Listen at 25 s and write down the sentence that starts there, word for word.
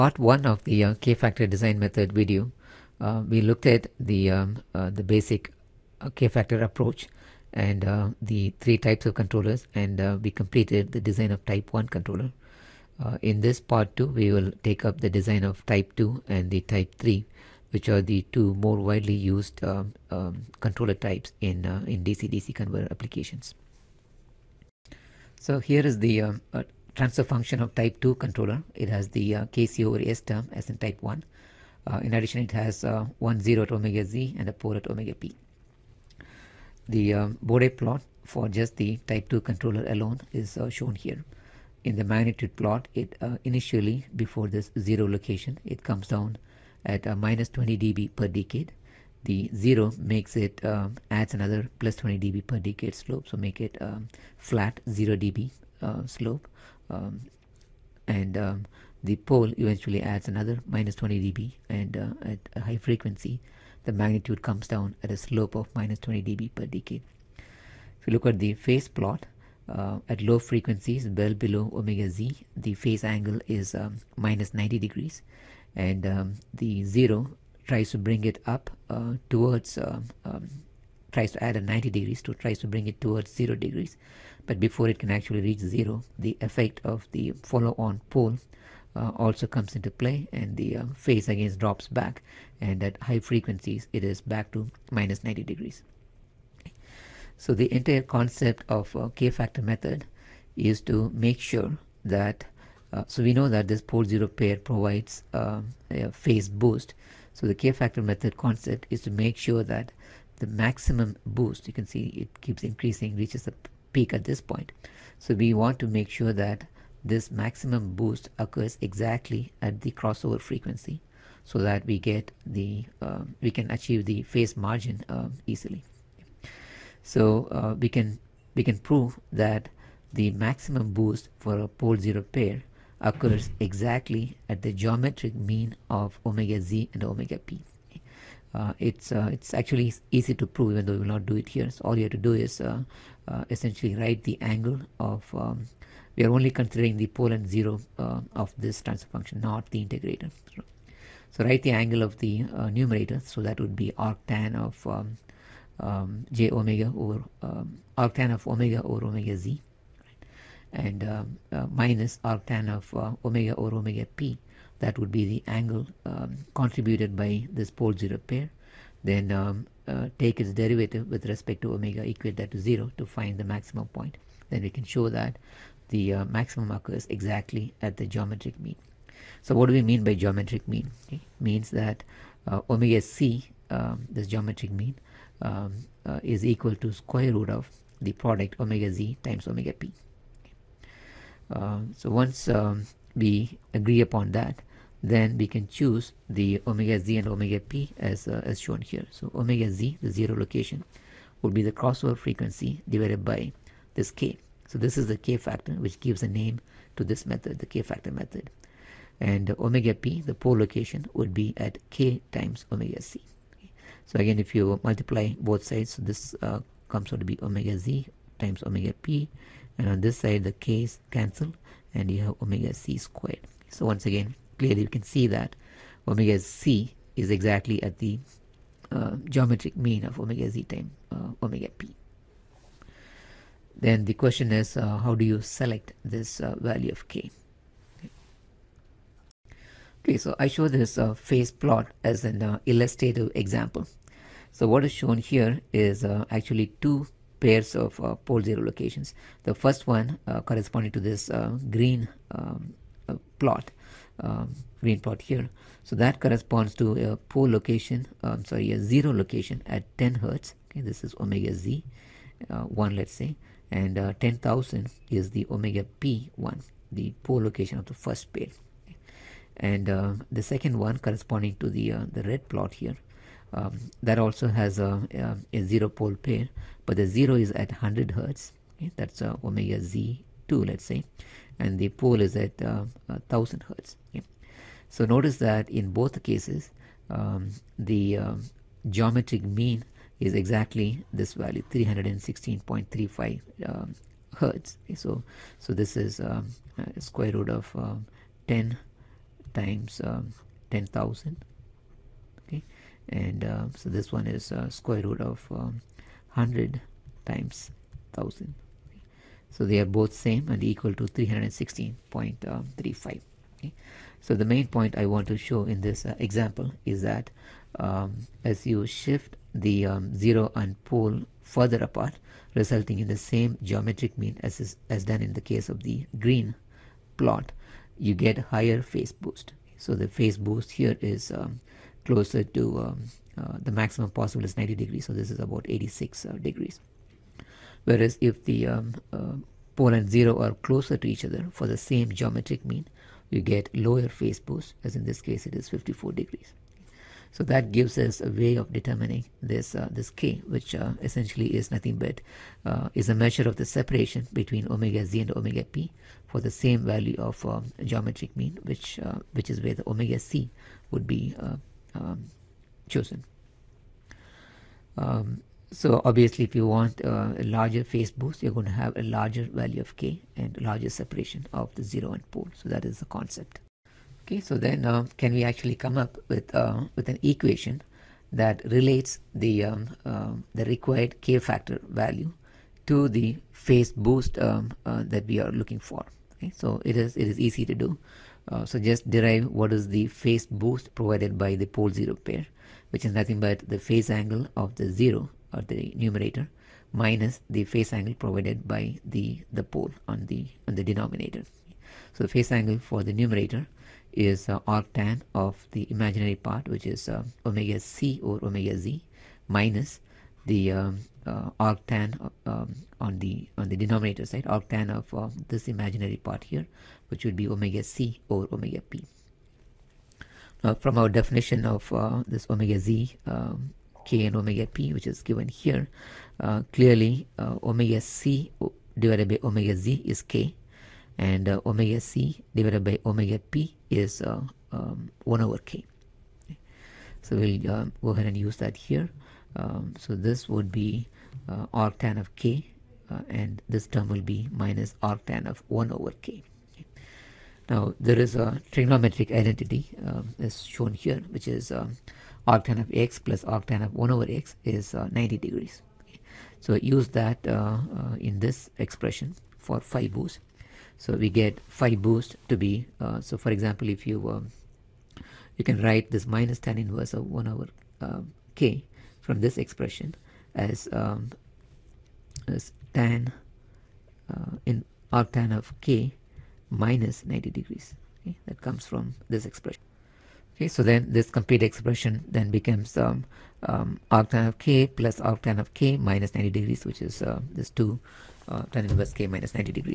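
So here is the um, transfer function of type 2 controller.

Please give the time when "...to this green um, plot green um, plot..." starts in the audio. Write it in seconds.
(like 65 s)
250 s.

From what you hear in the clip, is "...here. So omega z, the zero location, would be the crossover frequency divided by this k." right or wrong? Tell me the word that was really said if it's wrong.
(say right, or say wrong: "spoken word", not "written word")
right.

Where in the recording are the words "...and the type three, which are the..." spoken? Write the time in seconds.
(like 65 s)
16 s.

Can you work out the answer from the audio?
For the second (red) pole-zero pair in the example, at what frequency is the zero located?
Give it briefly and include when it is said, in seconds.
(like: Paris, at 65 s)
100 Hz, at 277 s.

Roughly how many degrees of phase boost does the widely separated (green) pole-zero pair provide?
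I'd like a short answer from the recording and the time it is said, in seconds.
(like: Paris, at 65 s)
86 degrees, at 335 s.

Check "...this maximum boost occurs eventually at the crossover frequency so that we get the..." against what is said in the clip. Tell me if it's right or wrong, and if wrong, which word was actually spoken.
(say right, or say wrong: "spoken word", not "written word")
wrong: "exactly", not "eventually".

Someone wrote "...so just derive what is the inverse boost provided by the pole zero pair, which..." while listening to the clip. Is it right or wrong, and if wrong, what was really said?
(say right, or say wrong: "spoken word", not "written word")
wrong: "phase", not "inverse".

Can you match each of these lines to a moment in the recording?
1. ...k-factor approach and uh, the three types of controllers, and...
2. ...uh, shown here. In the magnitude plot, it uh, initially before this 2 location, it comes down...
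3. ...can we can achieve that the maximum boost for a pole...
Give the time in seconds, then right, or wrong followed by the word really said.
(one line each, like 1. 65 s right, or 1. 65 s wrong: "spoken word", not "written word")
1. 6 s right
2. 40 s wrong: "0", not "2"
3. 127 s wrong: "prove", not "achieve".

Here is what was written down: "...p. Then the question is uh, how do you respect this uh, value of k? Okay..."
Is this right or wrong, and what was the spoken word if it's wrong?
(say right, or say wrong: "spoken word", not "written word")
wrong: "select", not "respect".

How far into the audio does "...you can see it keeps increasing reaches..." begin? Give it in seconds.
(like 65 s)
111 s.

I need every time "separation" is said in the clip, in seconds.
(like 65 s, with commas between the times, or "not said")
353 s, 370 s.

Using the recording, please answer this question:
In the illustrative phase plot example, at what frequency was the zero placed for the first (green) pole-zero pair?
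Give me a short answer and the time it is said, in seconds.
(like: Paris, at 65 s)
10 Hz, at 259 s.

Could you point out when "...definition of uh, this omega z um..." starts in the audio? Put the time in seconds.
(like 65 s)
421 s.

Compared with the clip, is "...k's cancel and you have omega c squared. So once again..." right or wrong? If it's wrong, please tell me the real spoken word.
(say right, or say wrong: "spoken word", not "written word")
right.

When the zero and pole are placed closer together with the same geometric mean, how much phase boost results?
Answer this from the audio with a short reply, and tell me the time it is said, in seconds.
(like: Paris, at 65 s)
54 degrees, at 345 s.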